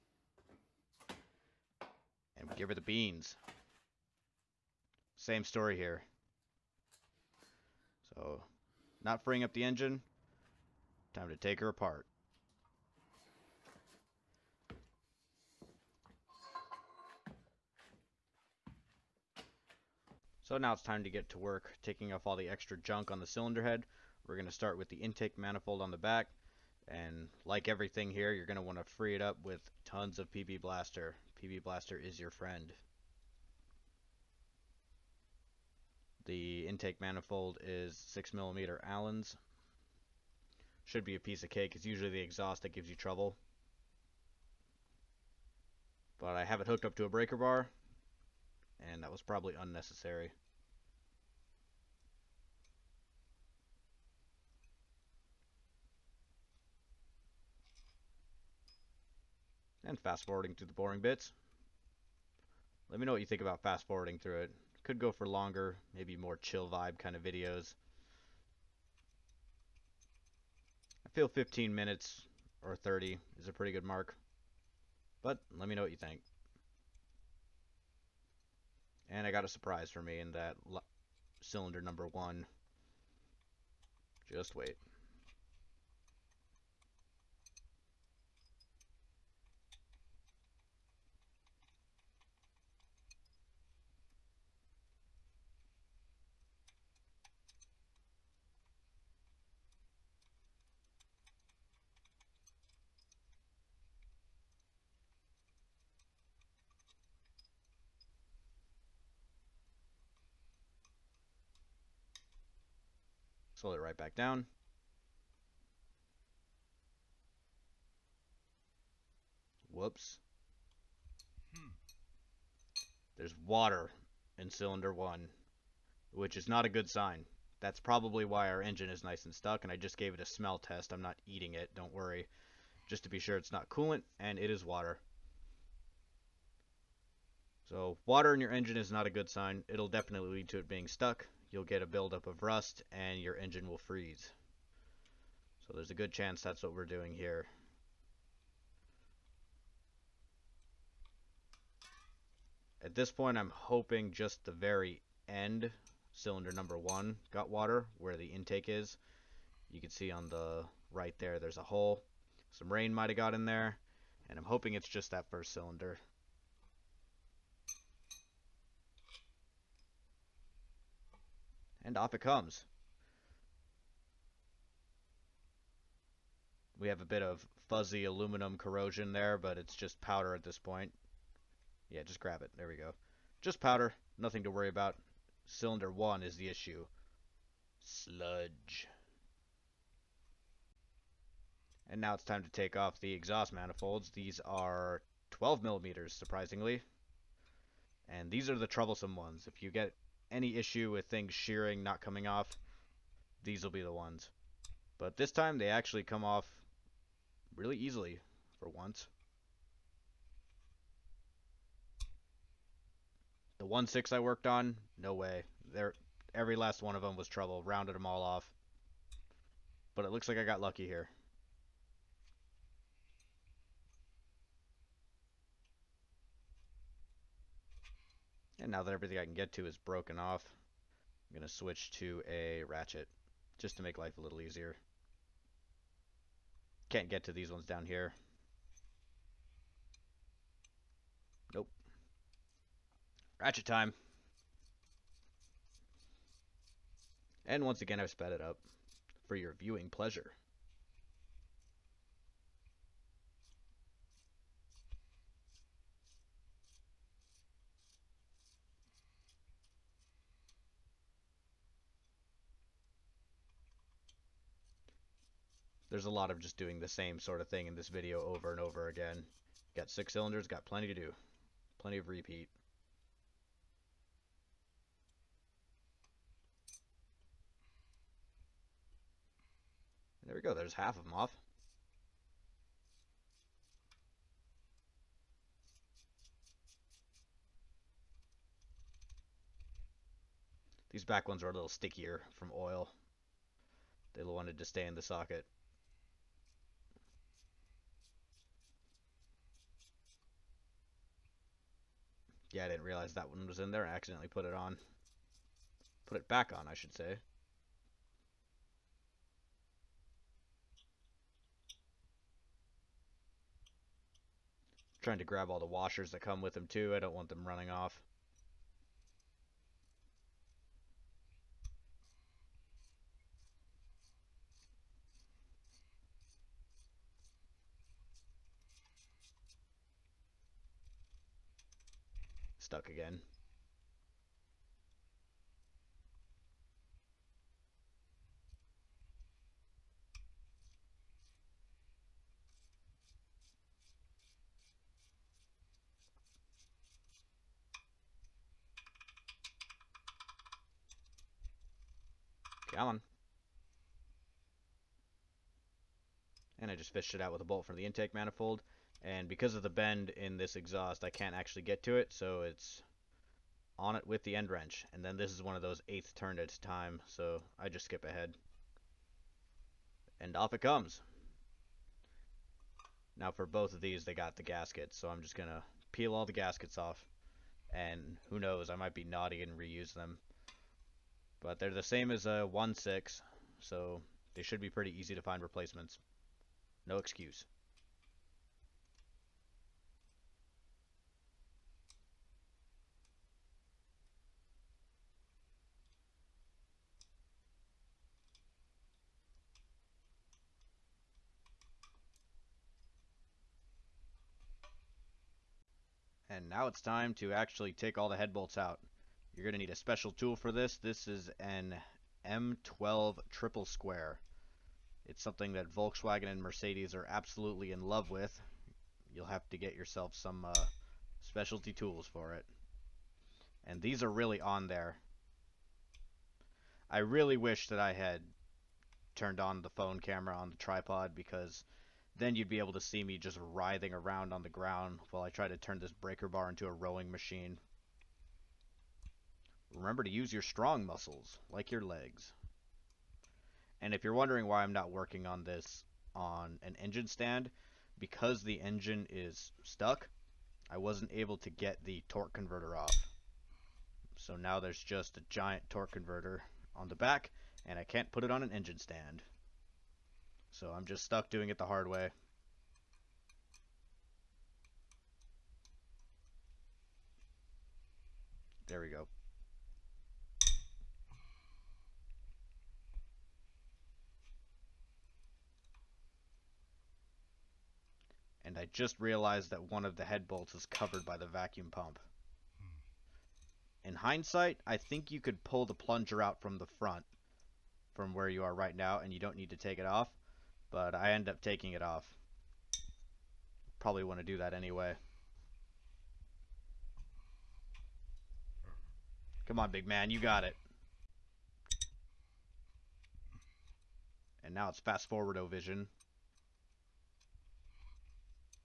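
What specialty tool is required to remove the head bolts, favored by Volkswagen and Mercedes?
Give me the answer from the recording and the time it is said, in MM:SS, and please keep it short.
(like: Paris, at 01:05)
M12 triple square, at 06:52.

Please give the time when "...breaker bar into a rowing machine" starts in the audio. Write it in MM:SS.
07:15.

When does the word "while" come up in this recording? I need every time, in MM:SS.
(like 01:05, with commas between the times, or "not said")
07:15.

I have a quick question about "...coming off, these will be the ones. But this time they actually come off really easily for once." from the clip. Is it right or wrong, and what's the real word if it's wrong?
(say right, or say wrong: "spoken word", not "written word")
right.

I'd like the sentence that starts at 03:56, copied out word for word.
Can't get to these ones down here.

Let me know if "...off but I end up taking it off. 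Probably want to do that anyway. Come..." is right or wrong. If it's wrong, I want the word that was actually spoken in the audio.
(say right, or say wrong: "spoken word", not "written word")
right.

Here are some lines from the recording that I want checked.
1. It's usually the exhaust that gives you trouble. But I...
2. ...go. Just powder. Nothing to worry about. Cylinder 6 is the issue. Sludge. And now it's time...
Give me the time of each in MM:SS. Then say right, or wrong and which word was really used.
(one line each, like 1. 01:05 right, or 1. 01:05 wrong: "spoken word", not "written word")
1. 00:41 right
2. 03:02 wrong: "1", not "6".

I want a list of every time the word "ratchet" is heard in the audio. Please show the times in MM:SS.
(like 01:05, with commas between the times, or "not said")
03:52, 04:03.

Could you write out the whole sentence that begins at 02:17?
So water in your engine is not a good sign.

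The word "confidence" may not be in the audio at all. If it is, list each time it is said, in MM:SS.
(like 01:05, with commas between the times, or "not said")
not said.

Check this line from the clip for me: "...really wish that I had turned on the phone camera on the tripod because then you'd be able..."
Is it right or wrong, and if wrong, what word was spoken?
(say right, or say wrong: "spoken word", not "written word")
right.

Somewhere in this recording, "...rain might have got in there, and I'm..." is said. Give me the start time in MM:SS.
02:42.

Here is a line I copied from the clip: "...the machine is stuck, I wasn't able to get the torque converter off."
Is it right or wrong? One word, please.
wrong.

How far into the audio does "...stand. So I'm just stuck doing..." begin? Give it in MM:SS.
07:38.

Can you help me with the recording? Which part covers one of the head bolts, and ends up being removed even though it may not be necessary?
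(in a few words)
Vacuum pump.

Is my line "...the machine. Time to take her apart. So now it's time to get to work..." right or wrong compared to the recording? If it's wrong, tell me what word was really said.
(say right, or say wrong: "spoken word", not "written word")
wrong: "engine", not "machine".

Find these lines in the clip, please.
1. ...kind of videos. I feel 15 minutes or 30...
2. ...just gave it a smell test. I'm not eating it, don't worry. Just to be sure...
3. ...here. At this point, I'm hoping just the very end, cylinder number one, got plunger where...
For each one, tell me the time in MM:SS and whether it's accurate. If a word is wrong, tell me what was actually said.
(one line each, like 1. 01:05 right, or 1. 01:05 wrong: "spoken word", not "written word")
1. 01:06 right
2. 02:09 right
3. 02:27 wrong: "water", not "plunger".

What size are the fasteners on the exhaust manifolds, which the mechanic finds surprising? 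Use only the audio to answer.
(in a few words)
12 millimeters.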